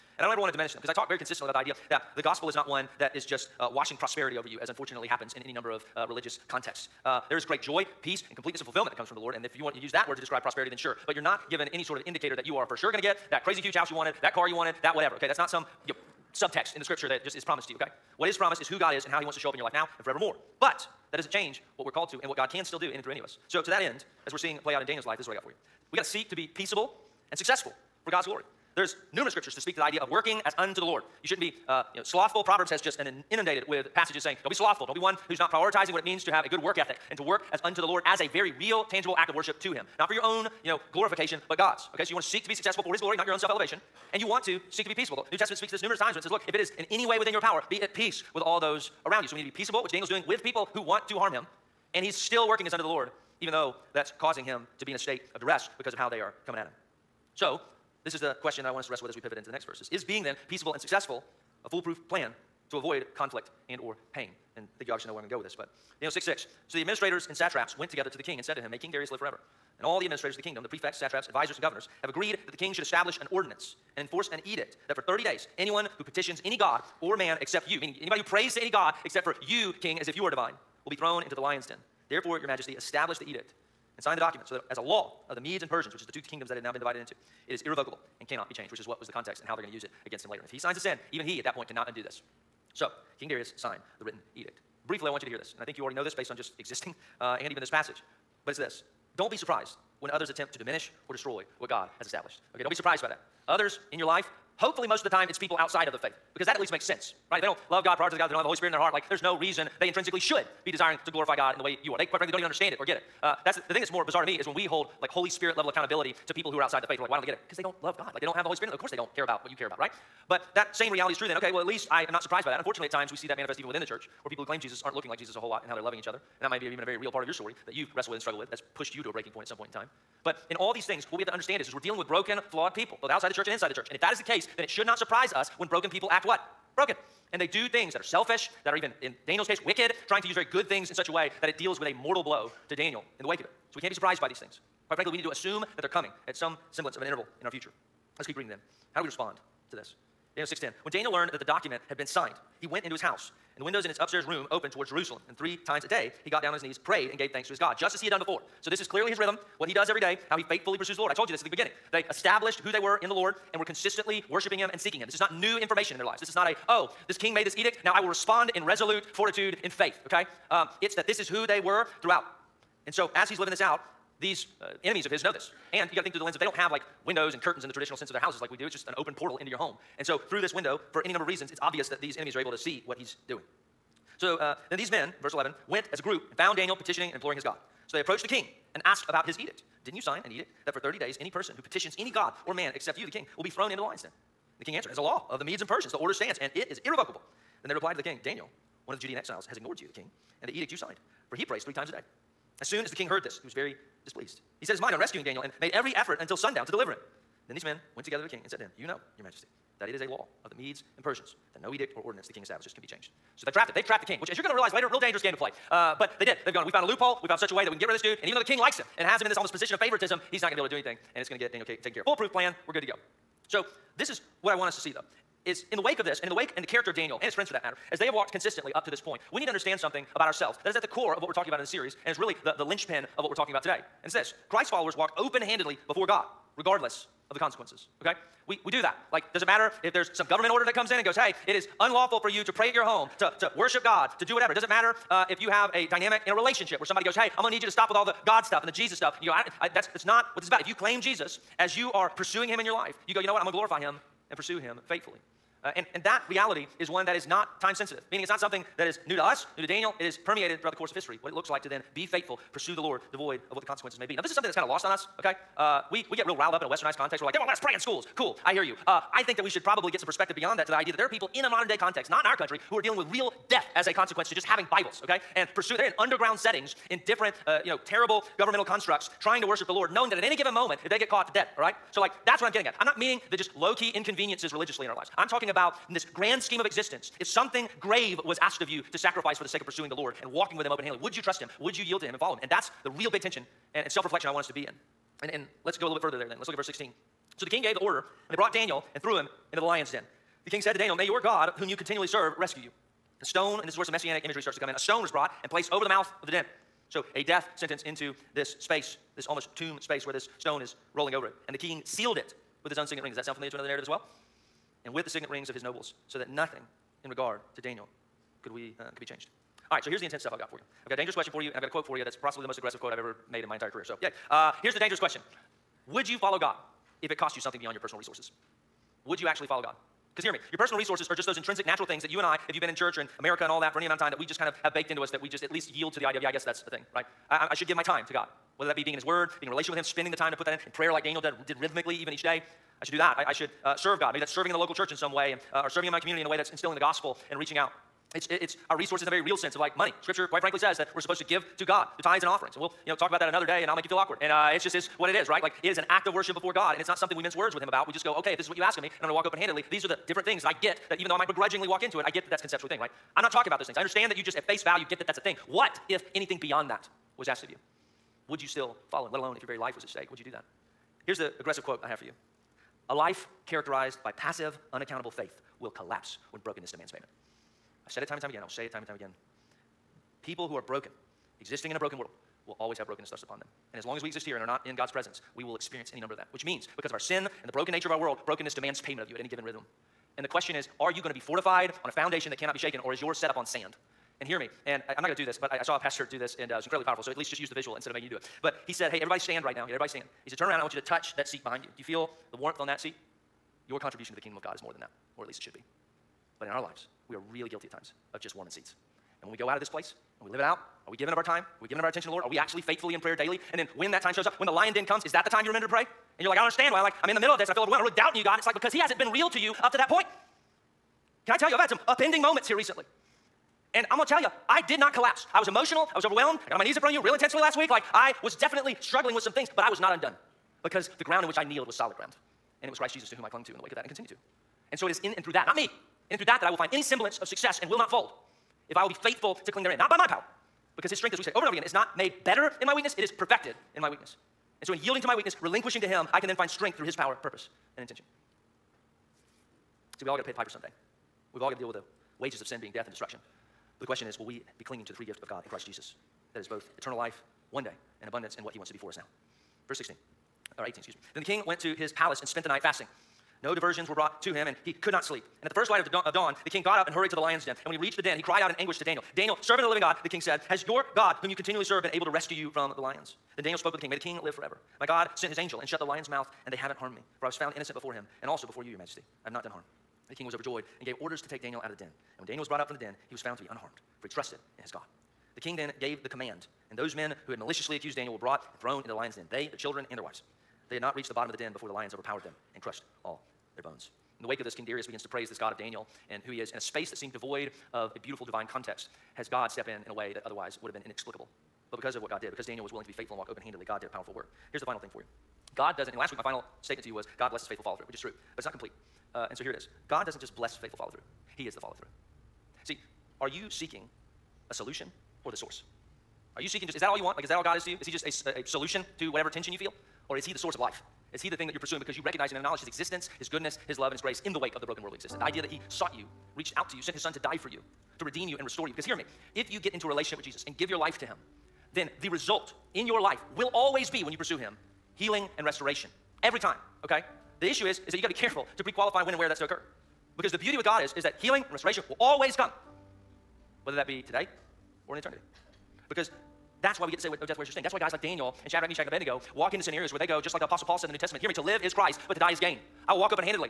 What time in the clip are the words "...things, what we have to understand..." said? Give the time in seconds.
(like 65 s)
130 s.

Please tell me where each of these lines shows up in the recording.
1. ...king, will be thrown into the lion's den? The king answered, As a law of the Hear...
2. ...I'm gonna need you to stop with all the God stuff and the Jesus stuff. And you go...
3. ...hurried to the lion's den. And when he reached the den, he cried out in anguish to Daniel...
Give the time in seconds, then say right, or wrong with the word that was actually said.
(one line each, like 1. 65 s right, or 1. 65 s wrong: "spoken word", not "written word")
1. 193 s wrong: "Medes", not "Hear"
2. 247 s right
3. 466 s right.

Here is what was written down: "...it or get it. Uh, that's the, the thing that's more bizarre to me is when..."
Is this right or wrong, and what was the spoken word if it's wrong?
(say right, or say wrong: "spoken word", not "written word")
right.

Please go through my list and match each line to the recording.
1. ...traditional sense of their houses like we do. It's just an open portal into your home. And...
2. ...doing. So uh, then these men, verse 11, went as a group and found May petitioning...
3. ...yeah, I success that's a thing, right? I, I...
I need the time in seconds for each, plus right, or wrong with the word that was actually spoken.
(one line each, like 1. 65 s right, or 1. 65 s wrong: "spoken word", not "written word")
1. 177 s right
2. 183 s wrong: "Daniel", not "May"
3. 336 s wrong: "guess", not "success".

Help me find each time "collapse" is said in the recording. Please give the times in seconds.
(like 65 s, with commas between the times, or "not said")
375 s, 424 s.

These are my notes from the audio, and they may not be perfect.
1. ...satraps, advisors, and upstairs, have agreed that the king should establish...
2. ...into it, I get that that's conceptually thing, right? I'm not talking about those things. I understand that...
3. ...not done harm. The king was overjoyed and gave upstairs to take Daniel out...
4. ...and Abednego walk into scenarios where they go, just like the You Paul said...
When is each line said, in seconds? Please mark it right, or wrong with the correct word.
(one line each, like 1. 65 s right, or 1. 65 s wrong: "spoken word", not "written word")
1. 70 s wrong: "governors", not "upstairs"
2. 361 s right
3. 479 s wrong: "orders", not "upstairs"
4. 548 s wrong: "Apostle", not "You".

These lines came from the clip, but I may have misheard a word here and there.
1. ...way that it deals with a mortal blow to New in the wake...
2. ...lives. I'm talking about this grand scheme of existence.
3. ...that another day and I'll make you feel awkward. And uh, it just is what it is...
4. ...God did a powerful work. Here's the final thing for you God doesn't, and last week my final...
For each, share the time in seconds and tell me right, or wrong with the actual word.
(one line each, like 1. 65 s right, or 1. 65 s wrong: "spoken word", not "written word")
1. 141 s wrong: "Daniel", not "New"
2. 284 s right
3. 353 s right
4. 503 s right.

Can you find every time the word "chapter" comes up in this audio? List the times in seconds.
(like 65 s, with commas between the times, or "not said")
not said.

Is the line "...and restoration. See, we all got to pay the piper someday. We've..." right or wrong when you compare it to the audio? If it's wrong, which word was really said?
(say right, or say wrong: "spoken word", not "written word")
wrong: "intention", not "restoration".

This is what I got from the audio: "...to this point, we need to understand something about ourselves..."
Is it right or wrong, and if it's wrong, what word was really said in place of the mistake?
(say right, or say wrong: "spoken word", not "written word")
right.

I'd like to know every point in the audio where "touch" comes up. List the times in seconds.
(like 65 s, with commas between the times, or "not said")
400 s.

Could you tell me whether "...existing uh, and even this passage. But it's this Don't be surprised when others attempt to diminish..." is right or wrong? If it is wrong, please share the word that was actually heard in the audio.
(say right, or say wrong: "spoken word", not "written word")
right.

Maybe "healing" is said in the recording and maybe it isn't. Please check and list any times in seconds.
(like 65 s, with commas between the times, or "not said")
534 s, 541 s.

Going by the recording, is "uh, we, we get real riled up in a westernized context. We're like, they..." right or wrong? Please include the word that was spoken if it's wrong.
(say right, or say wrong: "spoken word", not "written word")
right.